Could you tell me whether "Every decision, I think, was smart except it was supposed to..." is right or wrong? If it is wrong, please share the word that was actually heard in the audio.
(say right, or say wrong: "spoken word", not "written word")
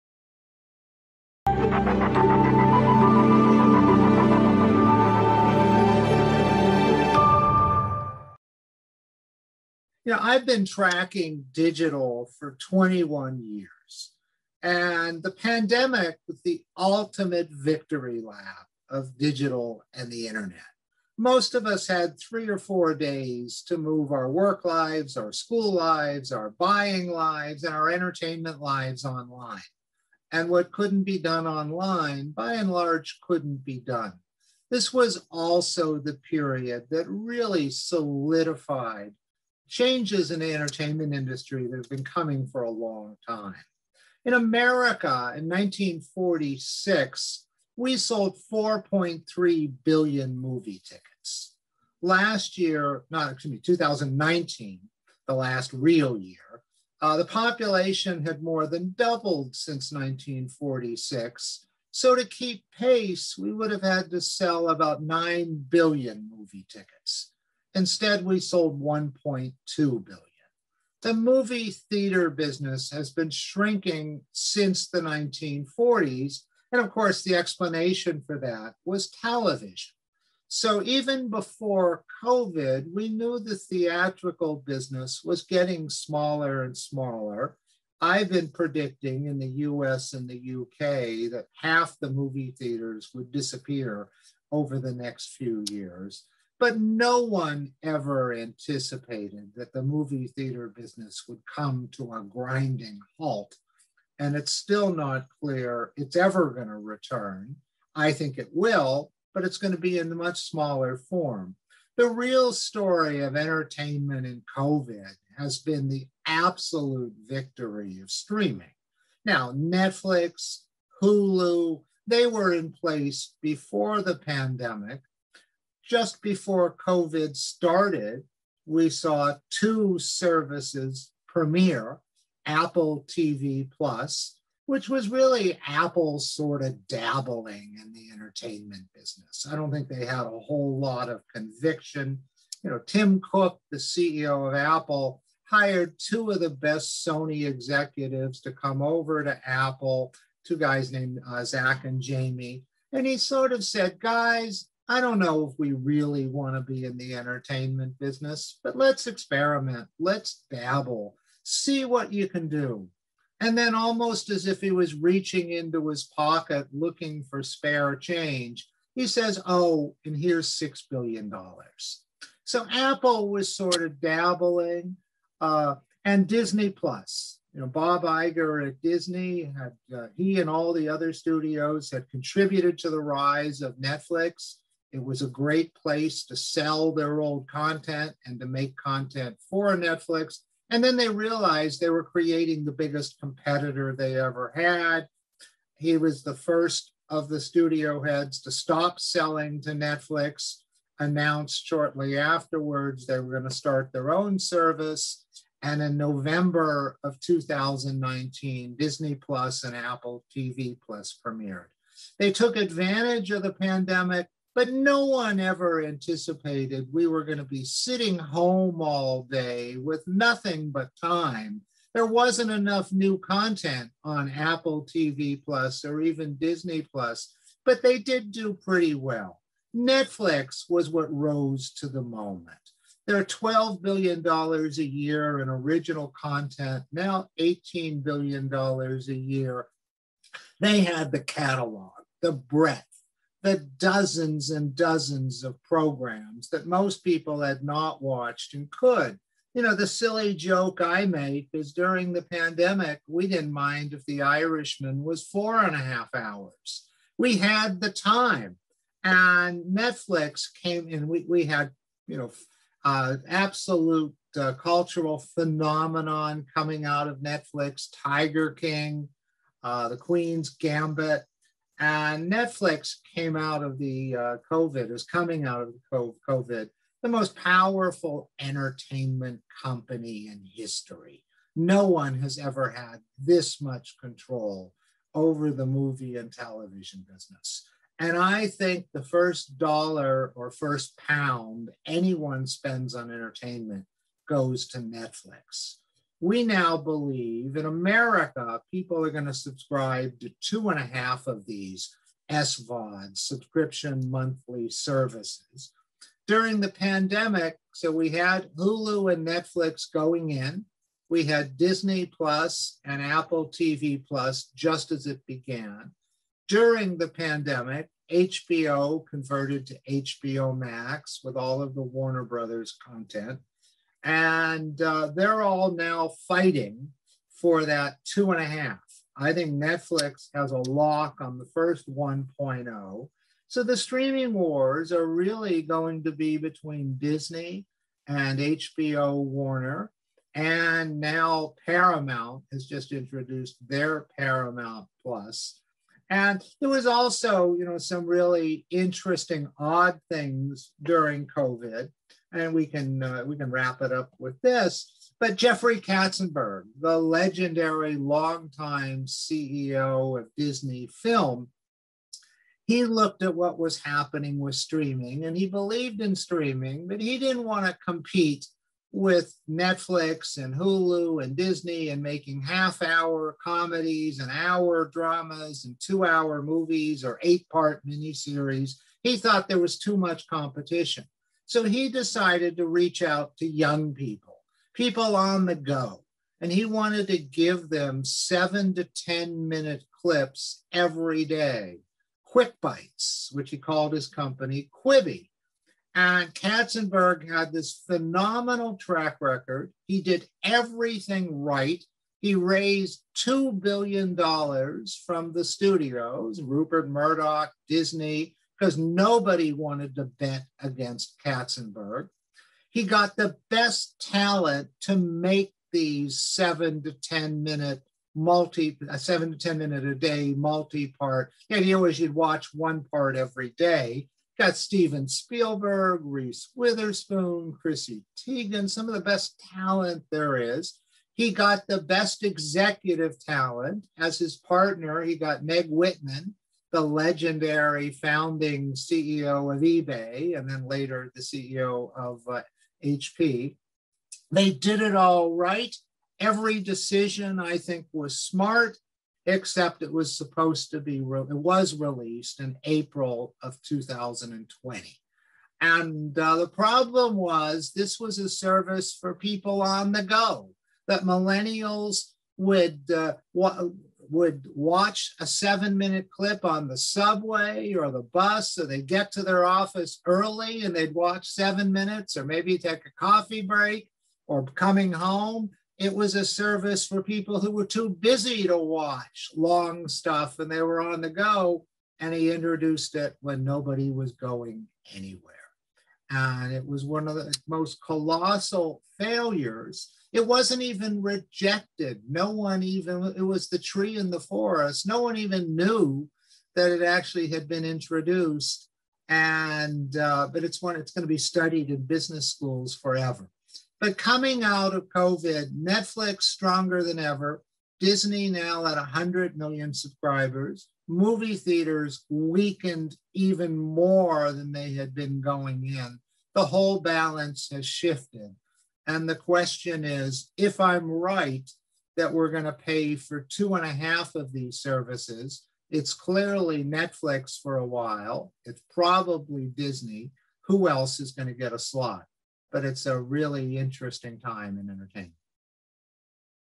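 right.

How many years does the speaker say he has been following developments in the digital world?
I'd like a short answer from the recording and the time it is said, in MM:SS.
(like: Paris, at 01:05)
21 years, at 00:12.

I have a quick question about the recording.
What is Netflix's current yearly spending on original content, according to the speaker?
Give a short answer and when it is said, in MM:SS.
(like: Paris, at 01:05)
$18 billion, at 03:57.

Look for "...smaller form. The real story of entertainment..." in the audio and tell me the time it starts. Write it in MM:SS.
01:50.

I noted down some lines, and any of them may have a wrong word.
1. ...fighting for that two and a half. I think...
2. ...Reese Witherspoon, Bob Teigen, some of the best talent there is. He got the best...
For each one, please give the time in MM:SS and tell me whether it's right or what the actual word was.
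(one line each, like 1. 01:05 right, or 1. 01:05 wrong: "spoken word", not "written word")
1. 05:26 right
2. 07:06 wrong: "Chrissy", not "Bob".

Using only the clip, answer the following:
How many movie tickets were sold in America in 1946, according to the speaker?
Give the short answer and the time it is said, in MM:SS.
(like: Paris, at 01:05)
4.3 billion, at 00:48.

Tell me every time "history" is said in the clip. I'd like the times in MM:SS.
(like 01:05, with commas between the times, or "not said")
04:40.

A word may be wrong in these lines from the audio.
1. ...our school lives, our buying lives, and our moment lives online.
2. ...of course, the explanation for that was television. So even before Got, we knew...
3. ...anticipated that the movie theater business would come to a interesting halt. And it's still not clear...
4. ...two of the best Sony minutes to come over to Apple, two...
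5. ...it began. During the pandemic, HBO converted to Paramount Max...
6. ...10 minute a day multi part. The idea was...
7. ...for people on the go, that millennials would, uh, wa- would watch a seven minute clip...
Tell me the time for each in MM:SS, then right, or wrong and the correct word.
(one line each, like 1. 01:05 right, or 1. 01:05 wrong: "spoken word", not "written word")
1. 00:25 wrong: "entertainment", not "moment"
2. 01:16 wrong: "COVID", not "Got"
3. 01:38 wrong: "grinding", not "interesting"
4. 02:25 wrong: "executives", not "minutes"
5. 05:15 wrong: "HBO", not "Paramount"
6. 06:59 right
7. 07:38 right.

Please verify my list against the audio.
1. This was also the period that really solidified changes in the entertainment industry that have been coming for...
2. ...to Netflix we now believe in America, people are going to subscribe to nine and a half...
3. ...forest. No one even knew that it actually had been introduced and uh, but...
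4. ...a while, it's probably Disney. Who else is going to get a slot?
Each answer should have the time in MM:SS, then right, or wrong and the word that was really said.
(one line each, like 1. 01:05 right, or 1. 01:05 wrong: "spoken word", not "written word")
1. 00:34 right
2. 04:54 wrong: "two", not "nine"
3. 08:14 right
4. 08:47 right.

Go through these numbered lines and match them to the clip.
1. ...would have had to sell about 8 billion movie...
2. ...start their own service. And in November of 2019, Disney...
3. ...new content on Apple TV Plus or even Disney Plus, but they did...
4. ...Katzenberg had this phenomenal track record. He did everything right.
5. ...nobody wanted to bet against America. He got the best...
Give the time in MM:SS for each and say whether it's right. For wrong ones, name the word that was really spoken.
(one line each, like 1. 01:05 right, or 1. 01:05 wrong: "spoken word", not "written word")
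1. 01:03 wrong: "9", not "8"
2. 03:23 right
3. 03:42 right
4. 06:36 right
5. 06:48 wrong: "Katzenberg", not "America".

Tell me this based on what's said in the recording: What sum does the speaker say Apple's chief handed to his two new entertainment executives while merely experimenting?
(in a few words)
$6 billion.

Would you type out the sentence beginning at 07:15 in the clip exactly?
He got Meg Whitman, the legendary founding CEO of eBay, and then later the CEO of uh, HP.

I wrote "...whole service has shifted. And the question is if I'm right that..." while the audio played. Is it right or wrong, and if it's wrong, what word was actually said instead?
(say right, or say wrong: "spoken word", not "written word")
wrong: "balance", not "service".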